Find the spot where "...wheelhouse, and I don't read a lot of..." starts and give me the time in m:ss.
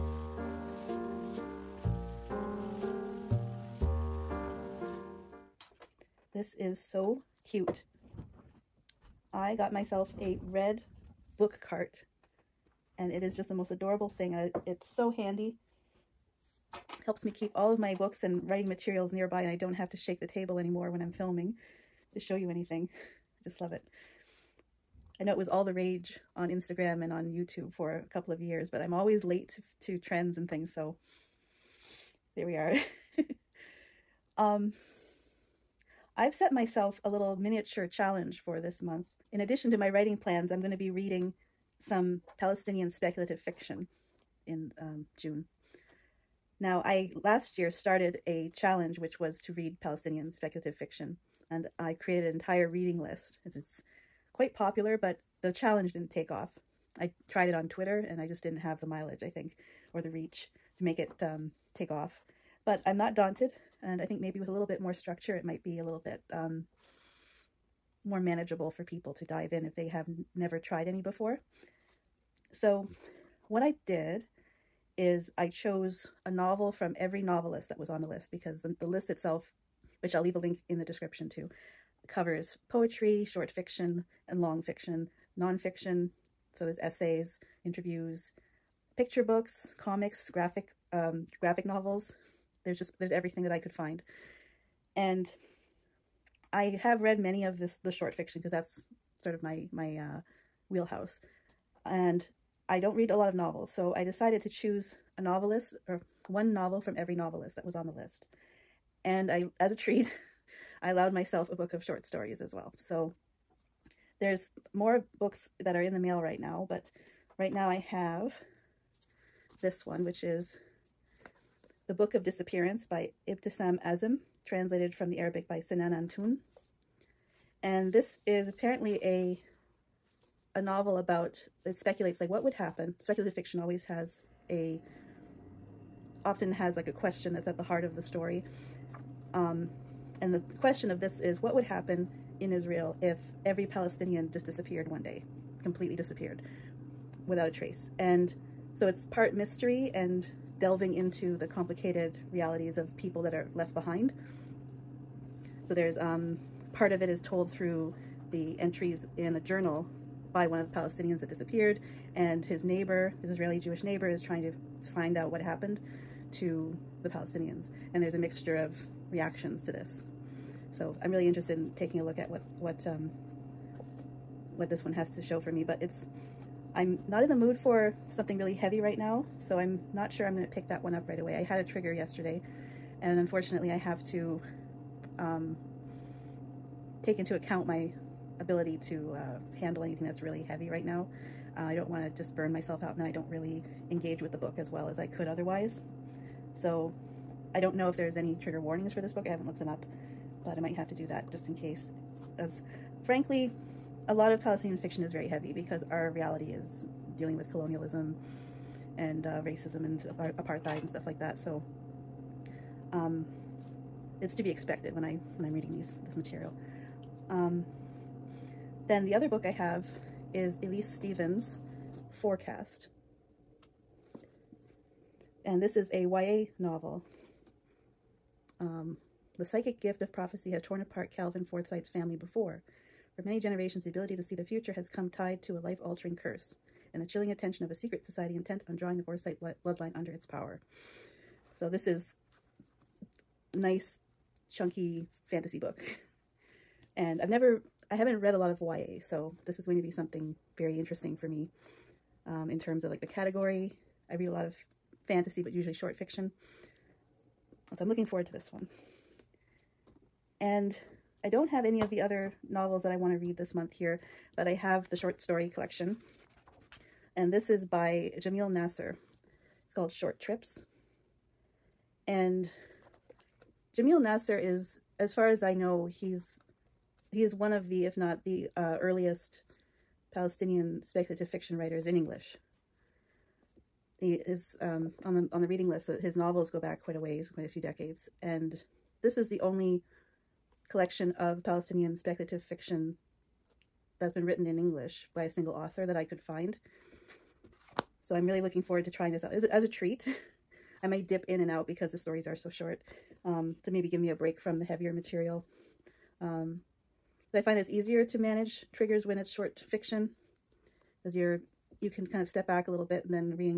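1:40.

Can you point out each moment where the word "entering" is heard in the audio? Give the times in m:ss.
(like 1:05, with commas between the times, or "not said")
not said.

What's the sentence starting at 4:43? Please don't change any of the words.
He is um, on the on the reading list.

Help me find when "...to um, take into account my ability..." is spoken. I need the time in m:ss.
3:04.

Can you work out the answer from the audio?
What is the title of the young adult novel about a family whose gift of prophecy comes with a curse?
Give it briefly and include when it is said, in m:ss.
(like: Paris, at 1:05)
Forecast, at 3:42.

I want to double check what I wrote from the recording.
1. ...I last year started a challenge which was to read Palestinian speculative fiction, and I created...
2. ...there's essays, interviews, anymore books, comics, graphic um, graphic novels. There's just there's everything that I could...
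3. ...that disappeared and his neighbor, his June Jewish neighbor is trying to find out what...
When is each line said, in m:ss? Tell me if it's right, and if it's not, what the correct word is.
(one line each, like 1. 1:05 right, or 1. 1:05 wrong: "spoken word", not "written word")
1. 0:46 right
2. 1:26 wrong: "picture", not "anymore"
3. 2:41 wrong: "Israeli", not "June".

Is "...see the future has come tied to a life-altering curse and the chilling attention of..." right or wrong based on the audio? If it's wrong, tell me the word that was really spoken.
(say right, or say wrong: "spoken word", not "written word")
right.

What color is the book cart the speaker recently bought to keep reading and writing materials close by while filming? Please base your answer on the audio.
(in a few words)
Red.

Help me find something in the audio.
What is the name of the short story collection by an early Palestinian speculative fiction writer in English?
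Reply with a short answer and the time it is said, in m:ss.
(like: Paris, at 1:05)
Short Trips, at 4:29.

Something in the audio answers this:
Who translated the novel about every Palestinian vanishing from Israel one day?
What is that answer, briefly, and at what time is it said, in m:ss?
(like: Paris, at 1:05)
Sinan Antoun, at 2:05.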